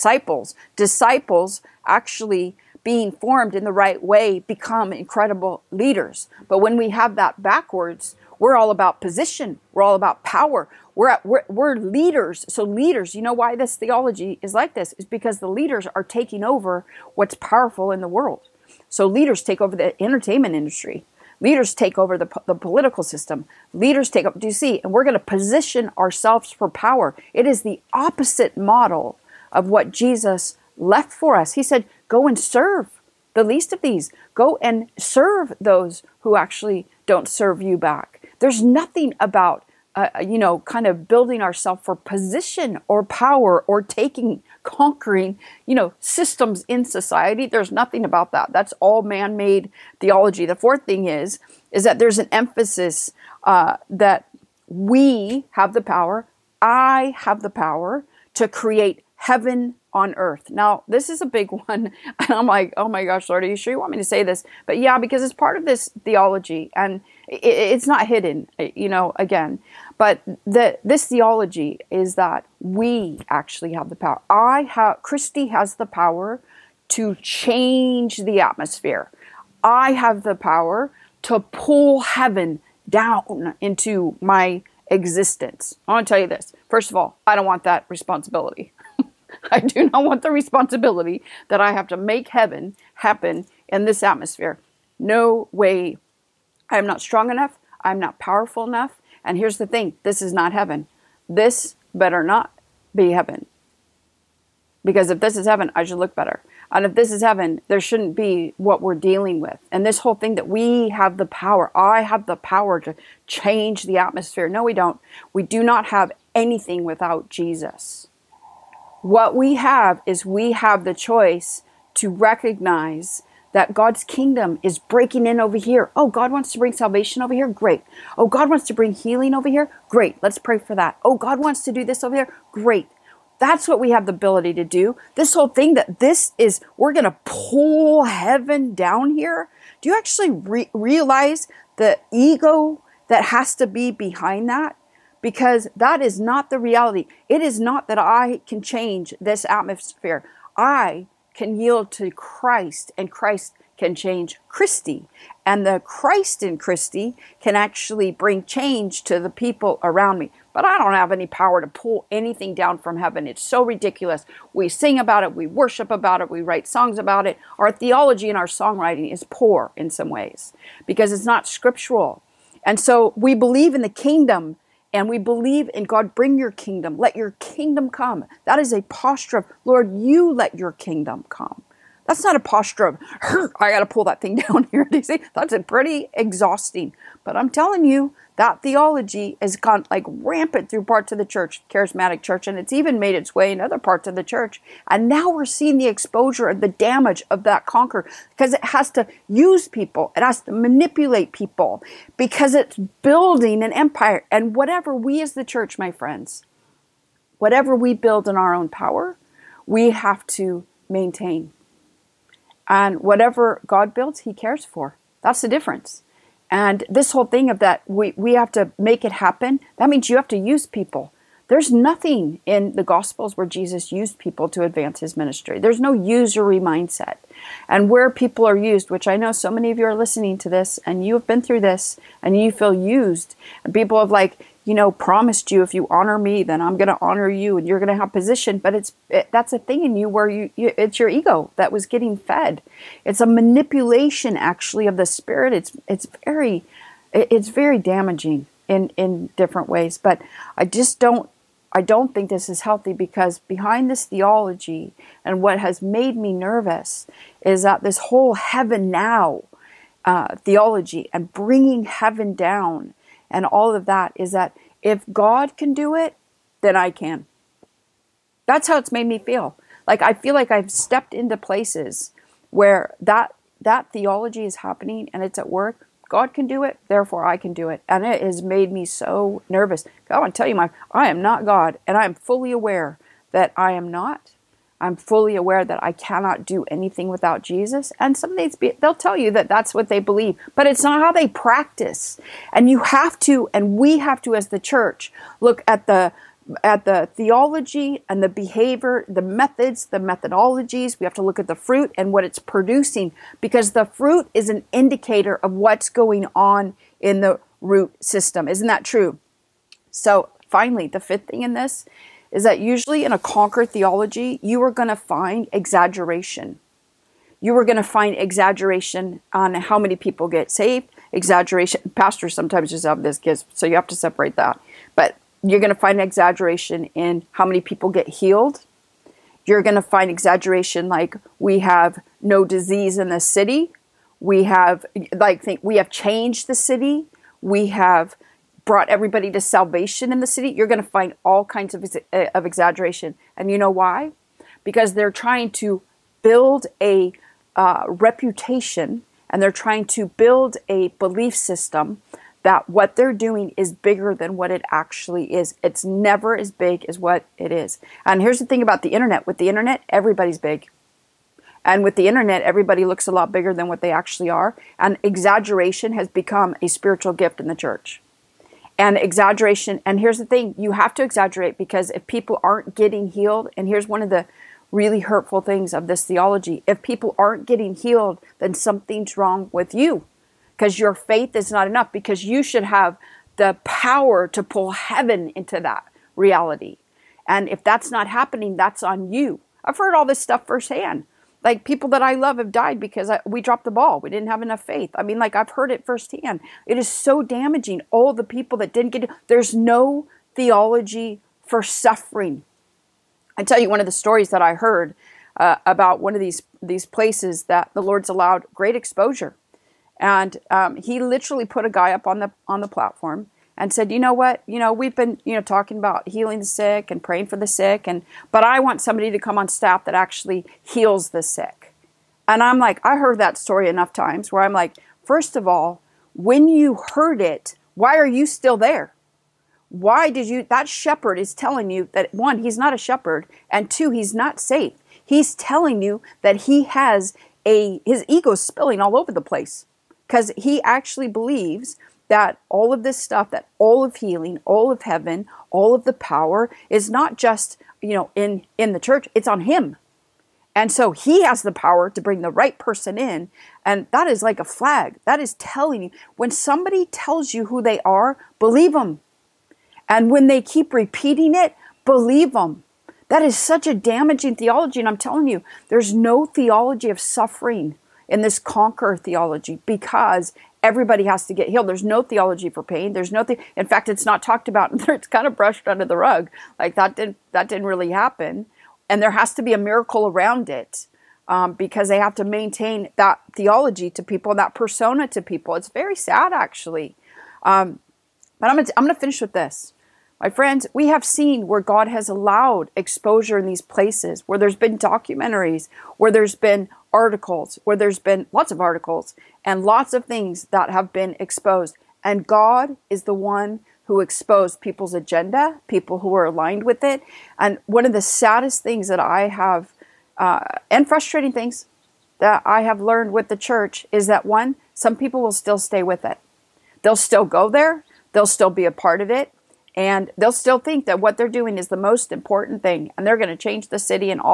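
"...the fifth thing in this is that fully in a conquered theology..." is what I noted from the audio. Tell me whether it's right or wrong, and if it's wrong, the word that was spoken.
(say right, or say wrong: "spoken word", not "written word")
wrong: "usually", not "fully".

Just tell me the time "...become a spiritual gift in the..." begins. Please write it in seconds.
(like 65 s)
366 s.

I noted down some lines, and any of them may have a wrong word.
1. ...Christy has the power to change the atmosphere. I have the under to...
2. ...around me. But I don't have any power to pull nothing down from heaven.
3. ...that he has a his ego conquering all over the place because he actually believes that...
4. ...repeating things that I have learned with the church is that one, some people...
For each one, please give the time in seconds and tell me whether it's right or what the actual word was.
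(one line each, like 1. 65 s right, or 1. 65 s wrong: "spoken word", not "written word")
1. 75 s wrong: "power", not "under"
2. 159 s wrong: "anything", not "nothing"
3. 436 s wrong: "spilling", not "conquering"
4. 510 s wrong: "frustrating", not "repeating".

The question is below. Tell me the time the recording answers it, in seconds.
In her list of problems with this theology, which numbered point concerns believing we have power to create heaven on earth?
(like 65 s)
50 s.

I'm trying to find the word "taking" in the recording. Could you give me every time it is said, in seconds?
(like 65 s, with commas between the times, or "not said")
16 s, 43 s.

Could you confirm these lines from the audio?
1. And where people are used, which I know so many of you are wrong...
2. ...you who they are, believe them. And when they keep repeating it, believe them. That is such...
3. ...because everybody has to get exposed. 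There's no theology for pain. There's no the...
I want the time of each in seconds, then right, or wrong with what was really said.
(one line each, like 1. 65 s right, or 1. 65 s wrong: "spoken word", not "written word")
1. 227 s wrong: "listening", not "wrong"
2. 457 s right
3. 469 s wrong: "healed", not "exposed".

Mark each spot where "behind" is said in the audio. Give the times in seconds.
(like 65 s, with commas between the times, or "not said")
143 s, 253 s.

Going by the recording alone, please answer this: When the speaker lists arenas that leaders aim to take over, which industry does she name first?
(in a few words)
entertainment industry.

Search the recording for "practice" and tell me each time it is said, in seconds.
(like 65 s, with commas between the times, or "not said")
291 s.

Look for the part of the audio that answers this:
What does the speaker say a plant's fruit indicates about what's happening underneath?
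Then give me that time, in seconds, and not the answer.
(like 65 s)
307 s.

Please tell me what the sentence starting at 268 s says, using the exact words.
That's how it's made me feel.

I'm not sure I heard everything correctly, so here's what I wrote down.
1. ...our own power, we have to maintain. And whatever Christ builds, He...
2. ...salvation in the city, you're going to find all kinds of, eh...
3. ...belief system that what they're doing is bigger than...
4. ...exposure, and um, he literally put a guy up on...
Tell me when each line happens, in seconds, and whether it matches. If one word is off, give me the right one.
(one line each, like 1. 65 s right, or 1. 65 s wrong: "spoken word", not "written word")
1. 208 s wrong: "God", not "Christ"
2. 339 s right
3. 350 s right
4. 408 s right.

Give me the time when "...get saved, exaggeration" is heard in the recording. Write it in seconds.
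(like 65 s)
320 s.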